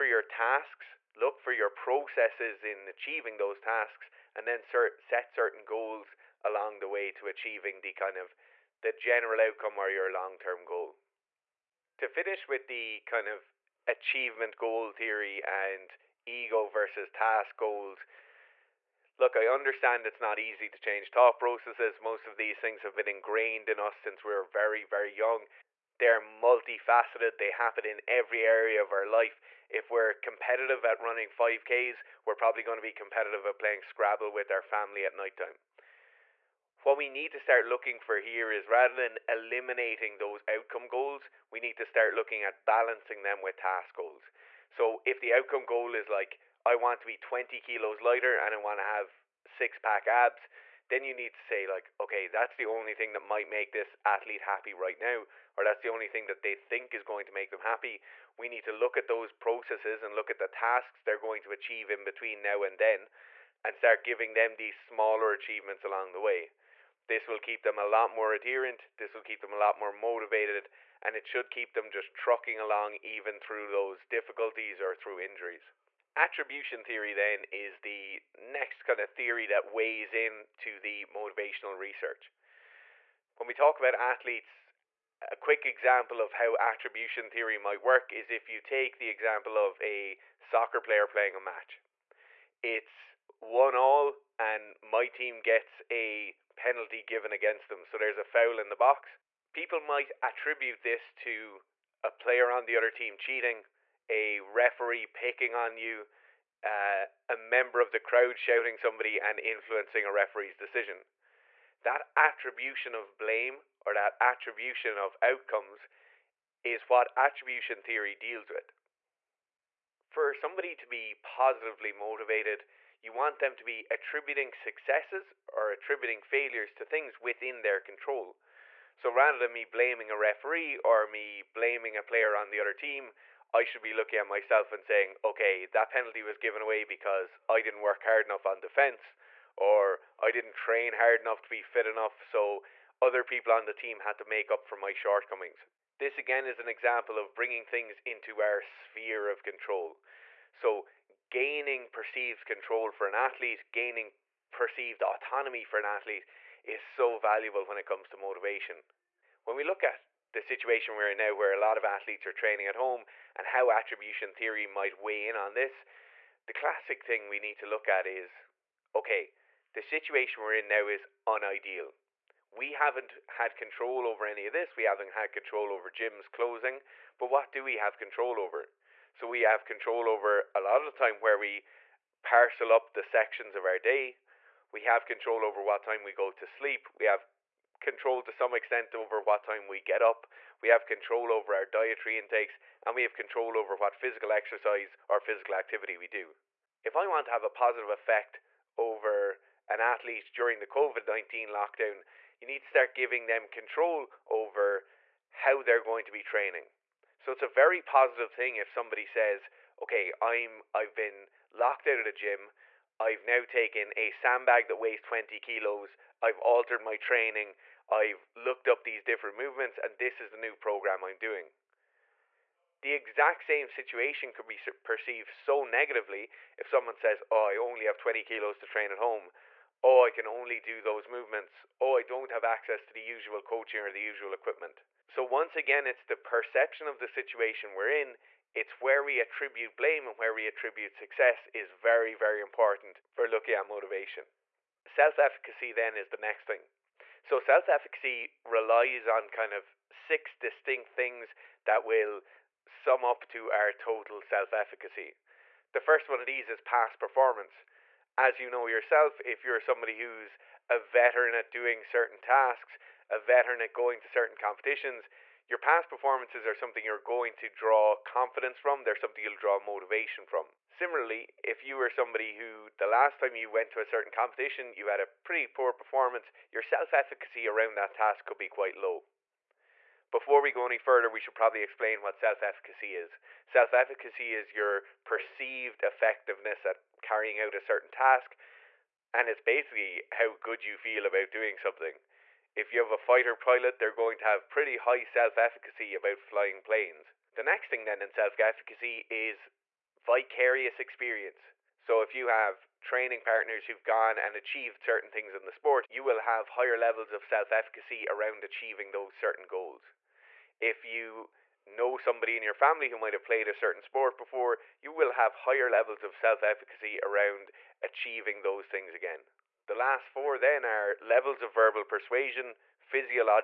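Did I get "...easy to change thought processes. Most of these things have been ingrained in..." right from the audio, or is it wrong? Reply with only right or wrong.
right.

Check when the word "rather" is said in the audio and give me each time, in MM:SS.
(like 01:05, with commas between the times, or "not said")
00:38, 02:09.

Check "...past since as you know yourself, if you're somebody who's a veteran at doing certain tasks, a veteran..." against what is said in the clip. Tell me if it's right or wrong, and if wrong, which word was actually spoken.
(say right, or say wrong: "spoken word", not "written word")
wrong: "performance", not "since".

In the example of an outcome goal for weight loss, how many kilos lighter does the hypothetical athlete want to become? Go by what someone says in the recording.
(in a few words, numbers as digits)
20.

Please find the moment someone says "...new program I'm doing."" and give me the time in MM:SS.
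03:40.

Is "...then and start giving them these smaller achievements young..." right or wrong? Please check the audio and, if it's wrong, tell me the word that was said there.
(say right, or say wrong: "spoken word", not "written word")
wrong: "along", not "young".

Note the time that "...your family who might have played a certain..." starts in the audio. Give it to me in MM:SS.
05:12.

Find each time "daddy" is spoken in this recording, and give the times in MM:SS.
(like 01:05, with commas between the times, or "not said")
not said.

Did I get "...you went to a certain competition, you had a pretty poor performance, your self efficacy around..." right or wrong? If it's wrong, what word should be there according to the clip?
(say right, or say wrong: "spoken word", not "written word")
right.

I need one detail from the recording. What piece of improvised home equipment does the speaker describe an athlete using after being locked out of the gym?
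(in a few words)
Sandbag.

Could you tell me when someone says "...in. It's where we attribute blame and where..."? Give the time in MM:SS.
03:57.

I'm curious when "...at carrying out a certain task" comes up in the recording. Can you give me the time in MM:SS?
04:46.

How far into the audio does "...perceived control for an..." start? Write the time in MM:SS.
02:31.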